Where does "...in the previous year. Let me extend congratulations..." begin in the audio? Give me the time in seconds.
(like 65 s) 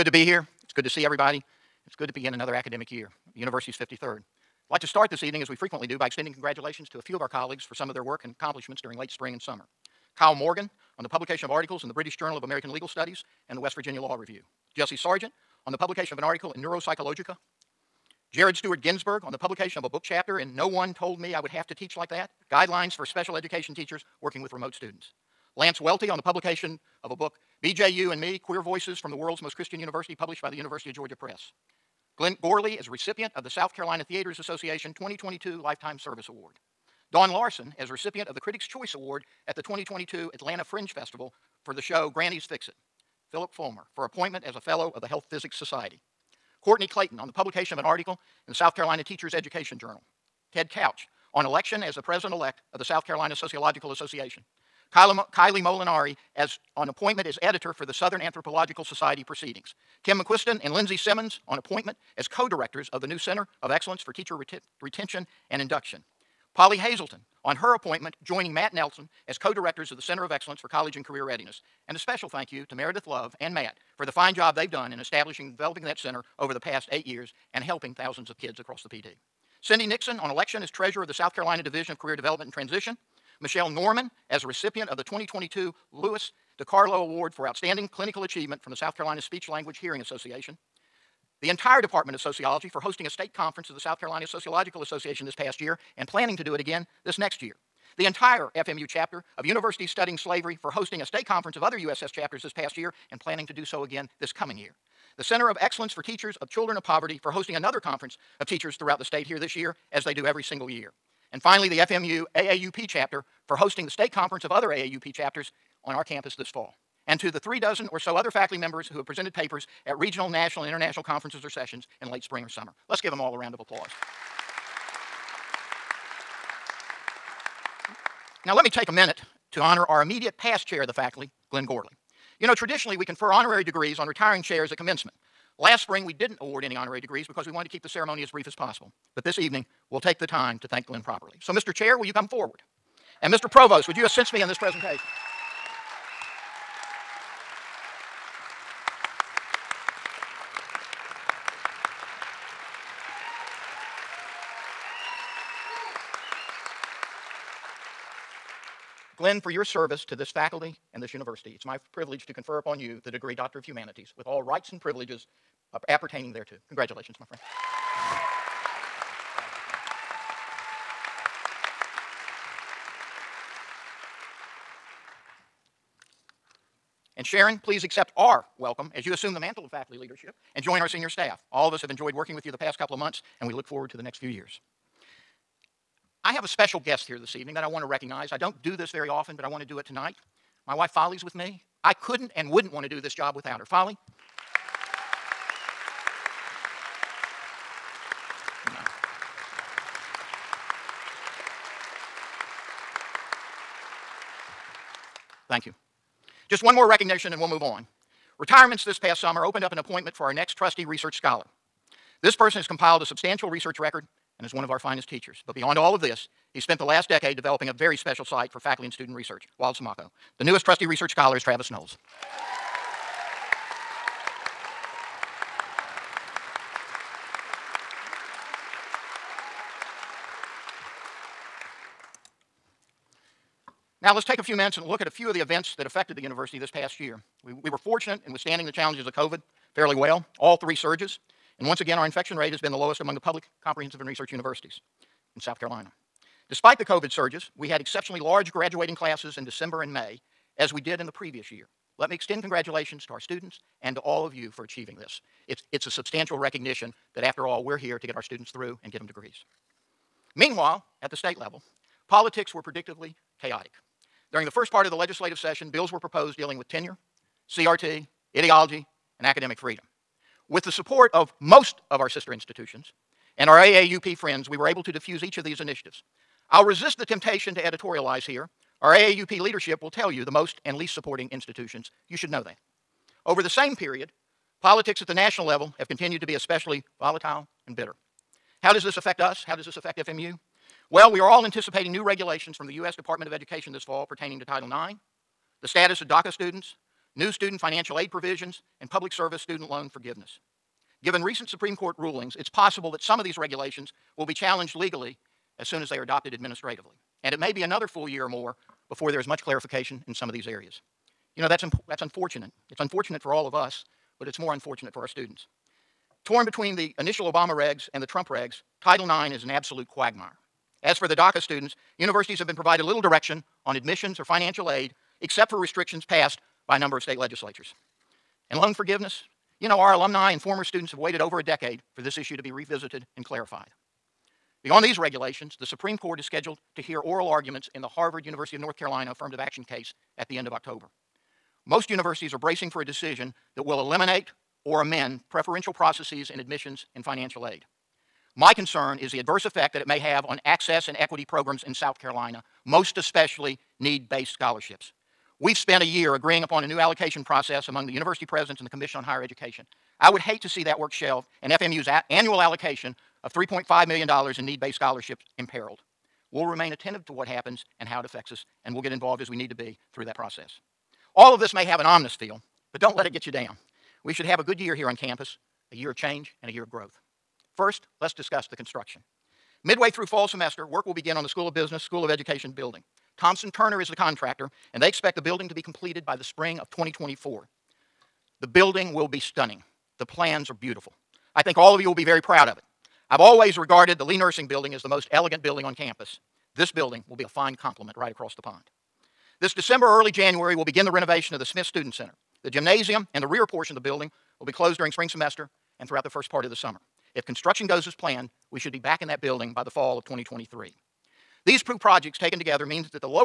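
250 s.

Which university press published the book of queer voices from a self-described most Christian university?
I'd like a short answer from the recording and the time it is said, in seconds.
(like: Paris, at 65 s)
University of Georgia Press, at 30 s.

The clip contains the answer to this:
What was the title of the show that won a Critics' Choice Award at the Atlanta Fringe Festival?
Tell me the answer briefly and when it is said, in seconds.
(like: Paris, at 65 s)
Granny's Fix It, at 42 s.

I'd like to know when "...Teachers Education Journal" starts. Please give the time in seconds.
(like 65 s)
49 s.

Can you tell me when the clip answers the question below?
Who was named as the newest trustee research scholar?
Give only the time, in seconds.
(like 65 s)
221 s.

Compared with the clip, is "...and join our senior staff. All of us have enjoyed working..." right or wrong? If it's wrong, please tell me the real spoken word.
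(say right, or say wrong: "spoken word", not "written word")
right.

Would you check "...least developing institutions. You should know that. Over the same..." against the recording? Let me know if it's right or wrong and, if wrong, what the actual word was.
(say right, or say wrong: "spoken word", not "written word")
wrong: "supporting", not "developing".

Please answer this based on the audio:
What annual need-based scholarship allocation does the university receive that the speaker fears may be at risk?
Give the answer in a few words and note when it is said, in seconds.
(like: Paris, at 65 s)
$3.5 million, at 363 s.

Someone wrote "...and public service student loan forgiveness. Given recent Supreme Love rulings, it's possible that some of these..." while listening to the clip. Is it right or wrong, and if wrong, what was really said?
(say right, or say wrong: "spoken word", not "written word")
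wrong: "Court", not "Love".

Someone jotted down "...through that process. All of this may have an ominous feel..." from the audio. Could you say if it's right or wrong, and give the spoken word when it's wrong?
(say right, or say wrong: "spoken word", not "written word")
right.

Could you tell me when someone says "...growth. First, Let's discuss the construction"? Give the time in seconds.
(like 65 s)
376 s.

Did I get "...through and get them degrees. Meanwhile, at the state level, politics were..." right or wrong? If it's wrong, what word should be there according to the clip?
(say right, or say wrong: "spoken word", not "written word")
right.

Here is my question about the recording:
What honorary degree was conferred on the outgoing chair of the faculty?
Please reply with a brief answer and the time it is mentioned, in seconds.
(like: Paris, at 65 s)
Doctor of Humanities, at 163 s.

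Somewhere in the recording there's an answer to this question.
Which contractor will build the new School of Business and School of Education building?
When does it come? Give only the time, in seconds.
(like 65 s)
383 s.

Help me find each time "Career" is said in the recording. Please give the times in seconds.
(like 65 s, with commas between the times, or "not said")
71 s, 81 s.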